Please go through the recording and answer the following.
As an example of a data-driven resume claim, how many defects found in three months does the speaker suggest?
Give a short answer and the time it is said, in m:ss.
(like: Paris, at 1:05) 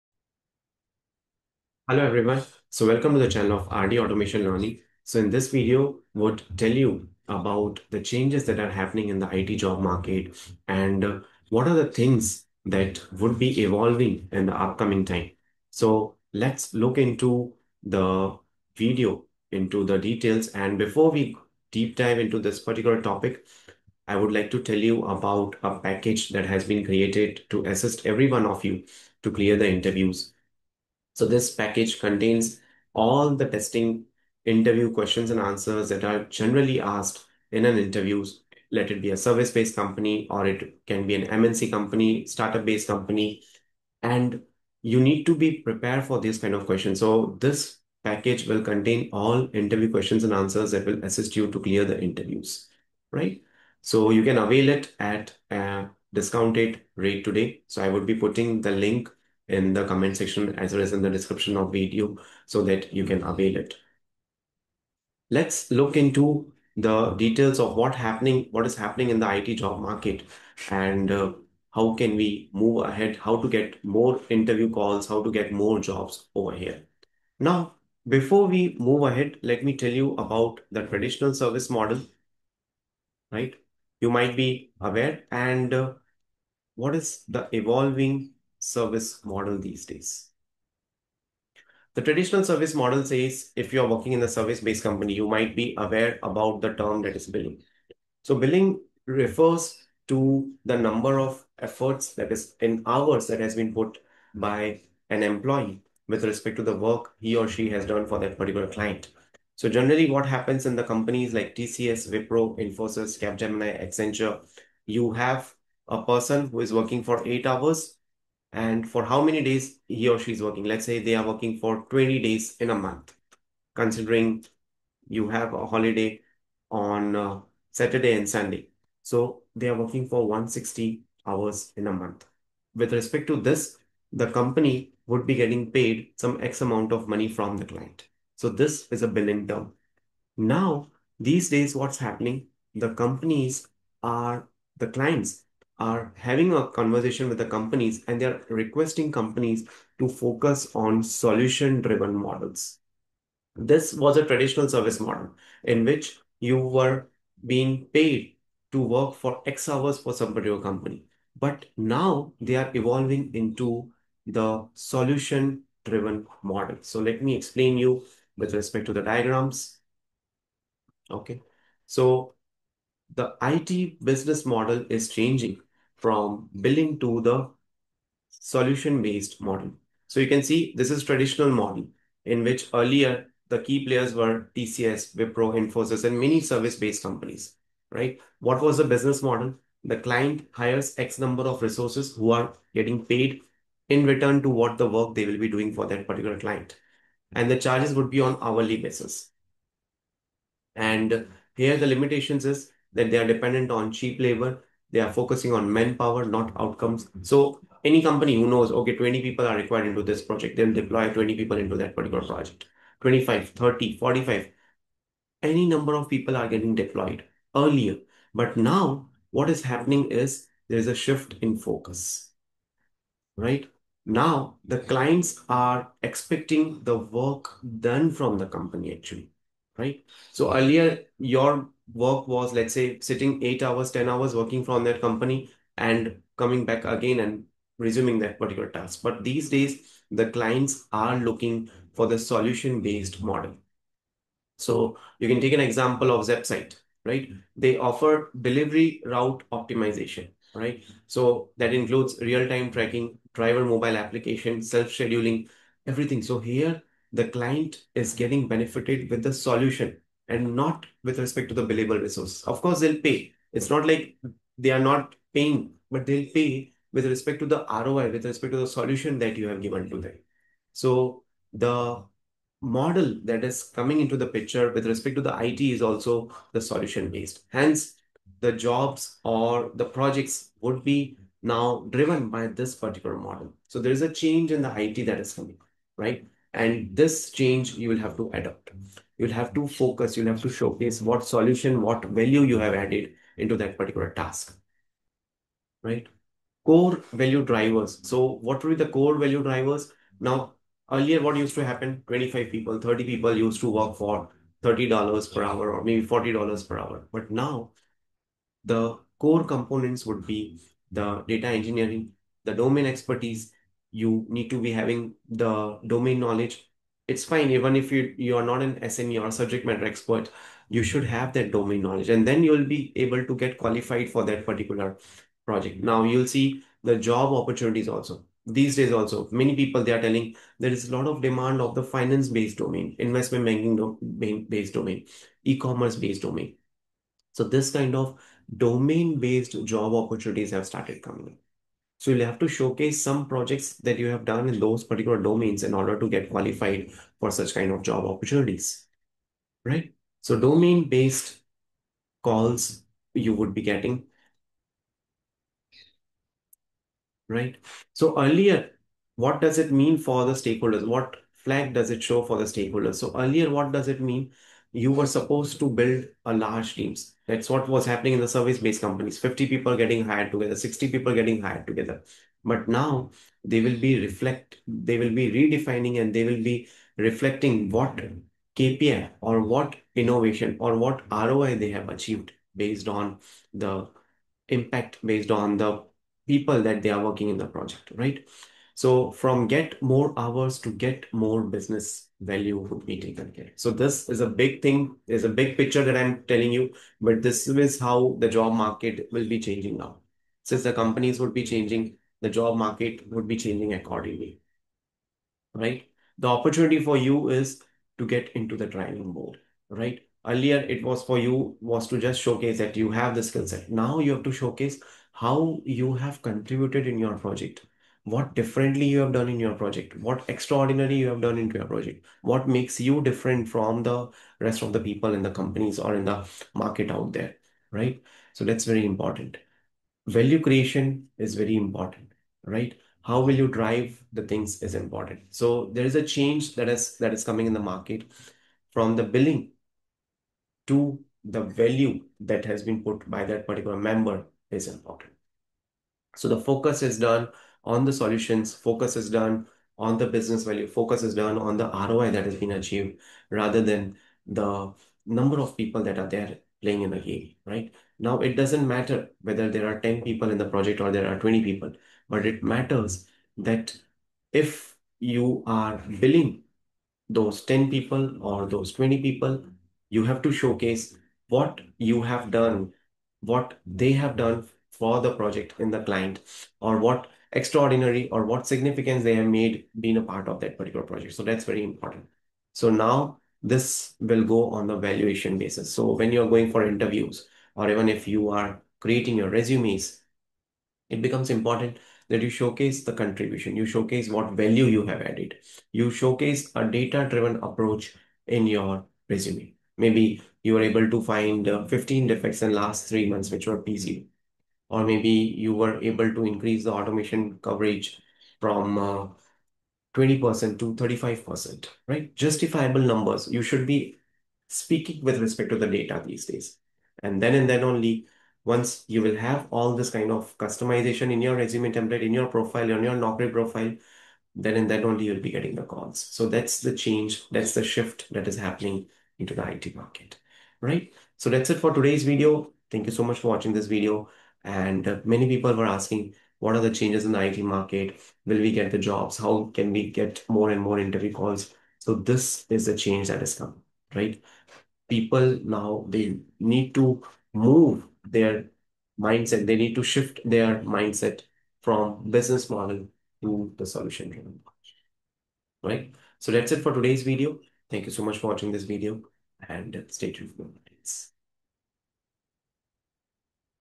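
15, at 8:21.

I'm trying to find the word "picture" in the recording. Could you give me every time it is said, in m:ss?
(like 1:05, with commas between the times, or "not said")
4:34, 6:35.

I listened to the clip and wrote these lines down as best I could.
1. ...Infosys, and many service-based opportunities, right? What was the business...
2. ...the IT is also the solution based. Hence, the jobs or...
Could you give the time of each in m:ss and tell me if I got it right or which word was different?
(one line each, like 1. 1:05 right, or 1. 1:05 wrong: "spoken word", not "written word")
1. 3:05 wrong: "companies", not "opportunities"
2. 4:35 right.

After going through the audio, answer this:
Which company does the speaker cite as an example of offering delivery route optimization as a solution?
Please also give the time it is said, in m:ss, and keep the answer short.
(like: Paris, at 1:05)
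ZapSight, at 4:06.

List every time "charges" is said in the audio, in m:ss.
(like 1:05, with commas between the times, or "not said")
3:17.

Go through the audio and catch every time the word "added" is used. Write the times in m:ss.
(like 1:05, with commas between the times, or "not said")
4:52, 8:15.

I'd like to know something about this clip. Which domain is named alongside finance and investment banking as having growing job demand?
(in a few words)
E-commerce.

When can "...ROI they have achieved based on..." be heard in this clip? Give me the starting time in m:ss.
6:21.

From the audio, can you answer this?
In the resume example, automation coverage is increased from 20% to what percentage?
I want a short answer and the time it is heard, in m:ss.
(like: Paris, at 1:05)
35%, at 8:30.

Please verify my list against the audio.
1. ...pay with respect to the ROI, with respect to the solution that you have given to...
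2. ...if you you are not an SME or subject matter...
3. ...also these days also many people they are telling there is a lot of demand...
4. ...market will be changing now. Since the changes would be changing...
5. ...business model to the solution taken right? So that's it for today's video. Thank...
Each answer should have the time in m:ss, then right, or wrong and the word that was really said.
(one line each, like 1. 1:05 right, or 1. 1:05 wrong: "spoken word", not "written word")
1. 4:26 right
2. 5:17 right
3. 5:27 right
4. 6:38 wrong: "companies", not "changes"
5. 9:12 wrong: "driven", not "taken".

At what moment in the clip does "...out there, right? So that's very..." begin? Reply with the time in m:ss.
7:06.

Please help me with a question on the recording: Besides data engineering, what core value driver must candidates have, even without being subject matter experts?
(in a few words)
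Domain expertise.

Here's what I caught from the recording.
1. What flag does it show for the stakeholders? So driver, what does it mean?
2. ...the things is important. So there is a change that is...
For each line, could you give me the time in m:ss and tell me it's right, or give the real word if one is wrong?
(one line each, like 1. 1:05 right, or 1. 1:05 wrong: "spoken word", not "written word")
1. 6:00 wrong: "earlier", not "driver"
2. 7:14 right.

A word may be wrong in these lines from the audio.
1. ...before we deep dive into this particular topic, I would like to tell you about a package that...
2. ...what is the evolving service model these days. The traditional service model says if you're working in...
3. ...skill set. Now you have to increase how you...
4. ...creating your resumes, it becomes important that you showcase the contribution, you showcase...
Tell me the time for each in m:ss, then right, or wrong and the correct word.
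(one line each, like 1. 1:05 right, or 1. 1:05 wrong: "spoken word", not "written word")
1. 0:20 right
2. 1:26 right
3. 6:53 wrong: "showcase", not "increase"
4. 8:08 right.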